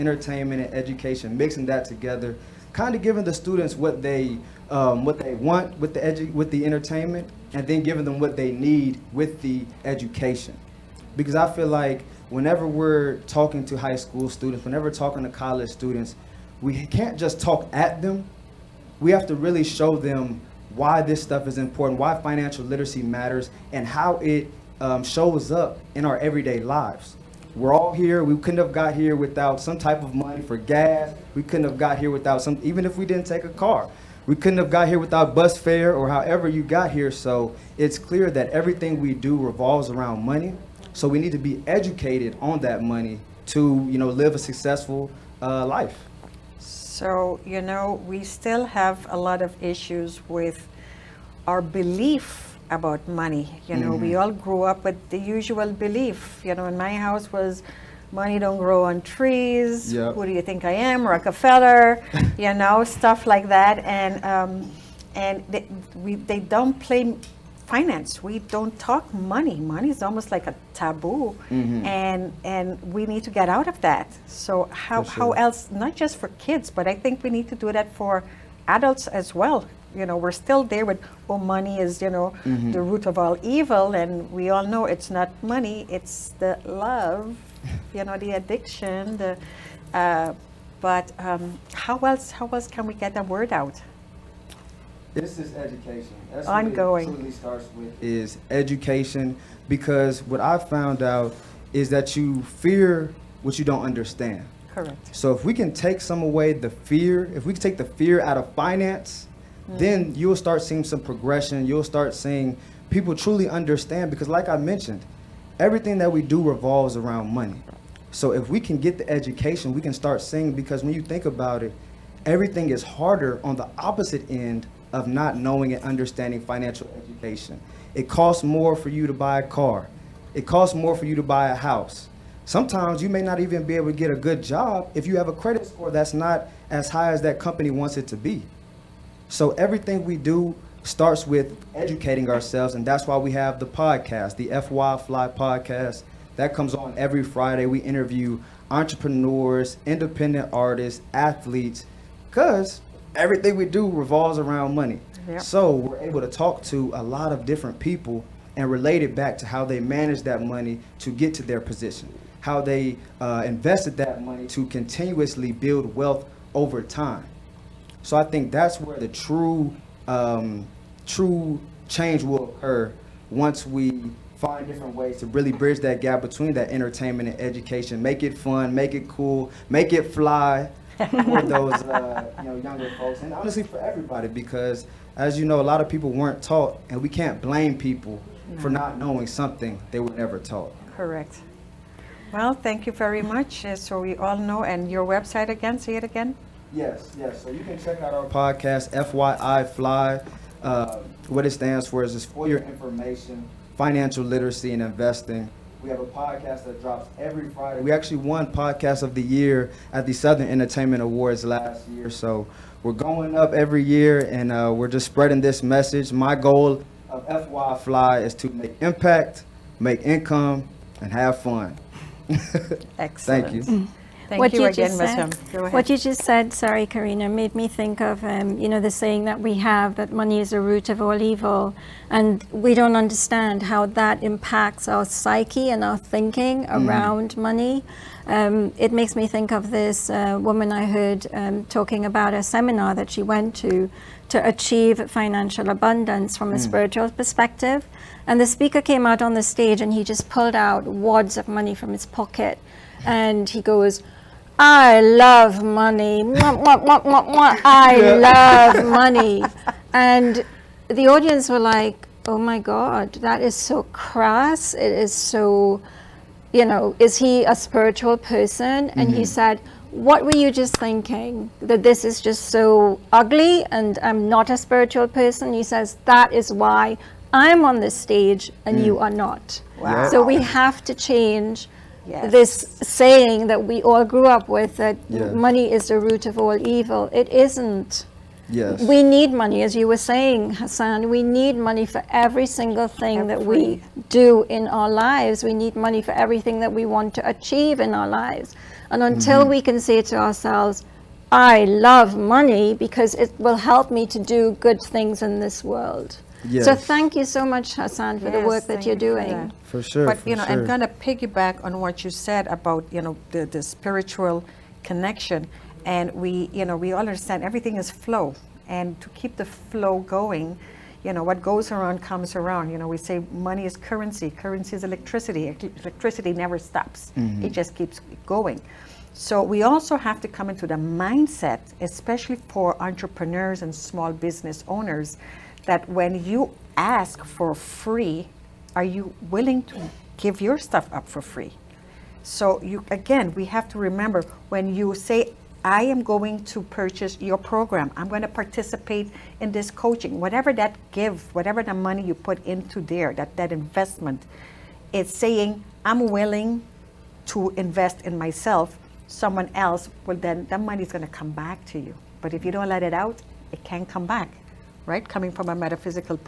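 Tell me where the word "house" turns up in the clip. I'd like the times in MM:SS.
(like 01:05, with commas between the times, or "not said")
00:57, 02:11.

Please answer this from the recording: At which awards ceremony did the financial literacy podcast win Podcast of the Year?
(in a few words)
Southern Entertainment Awards.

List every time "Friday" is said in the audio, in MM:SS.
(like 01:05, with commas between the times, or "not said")
02:27, 03:27.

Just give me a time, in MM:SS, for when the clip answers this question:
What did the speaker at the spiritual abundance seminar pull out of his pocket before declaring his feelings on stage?
04:10.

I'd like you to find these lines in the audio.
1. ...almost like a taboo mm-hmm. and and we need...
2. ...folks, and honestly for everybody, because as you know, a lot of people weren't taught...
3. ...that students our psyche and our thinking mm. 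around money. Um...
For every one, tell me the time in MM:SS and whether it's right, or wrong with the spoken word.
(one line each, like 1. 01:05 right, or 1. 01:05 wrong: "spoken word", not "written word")
1. 01:10 right
2. 03:02 right
3. 03:53 wrong: "impacts", not "students".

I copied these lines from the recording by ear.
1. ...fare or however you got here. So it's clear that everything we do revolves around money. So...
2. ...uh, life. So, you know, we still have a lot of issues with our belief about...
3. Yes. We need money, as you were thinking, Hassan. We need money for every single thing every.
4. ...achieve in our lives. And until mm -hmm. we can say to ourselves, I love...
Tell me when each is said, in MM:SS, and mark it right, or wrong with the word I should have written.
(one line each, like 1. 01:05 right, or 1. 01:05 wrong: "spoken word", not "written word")
1. 00:35 right
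2. 00:45 right
3. 04:48 wrong: "saying", not "thinking"
4. 04:57 right.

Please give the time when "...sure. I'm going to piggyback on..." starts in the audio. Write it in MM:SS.
05:10.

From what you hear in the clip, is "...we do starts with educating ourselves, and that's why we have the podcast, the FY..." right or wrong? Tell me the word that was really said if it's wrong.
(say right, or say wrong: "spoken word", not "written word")
right.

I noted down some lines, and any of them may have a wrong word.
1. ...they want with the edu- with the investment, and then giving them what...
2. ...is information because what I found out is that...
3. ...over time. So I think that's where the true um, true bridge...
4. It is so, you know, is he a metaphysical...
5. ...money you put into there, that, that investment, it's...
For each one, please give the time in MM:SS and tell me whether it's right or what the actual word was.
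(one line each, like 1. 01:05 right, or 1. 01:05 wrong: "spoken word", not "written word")
1. 00:05 wrong: "entertainment", not "investment"
2. 01:38 wrong: "education", not "information"
3. 02:46 wrong: "change", not "bridge"
4. 04:24 wrong: "spiritual", not "metaphysical"
5. 05:51 right.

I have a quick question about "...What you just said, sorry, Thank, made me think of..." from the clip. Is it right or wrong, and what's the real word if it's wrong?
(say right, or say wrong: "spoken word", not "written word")
wrong: "Karina", not "Thank".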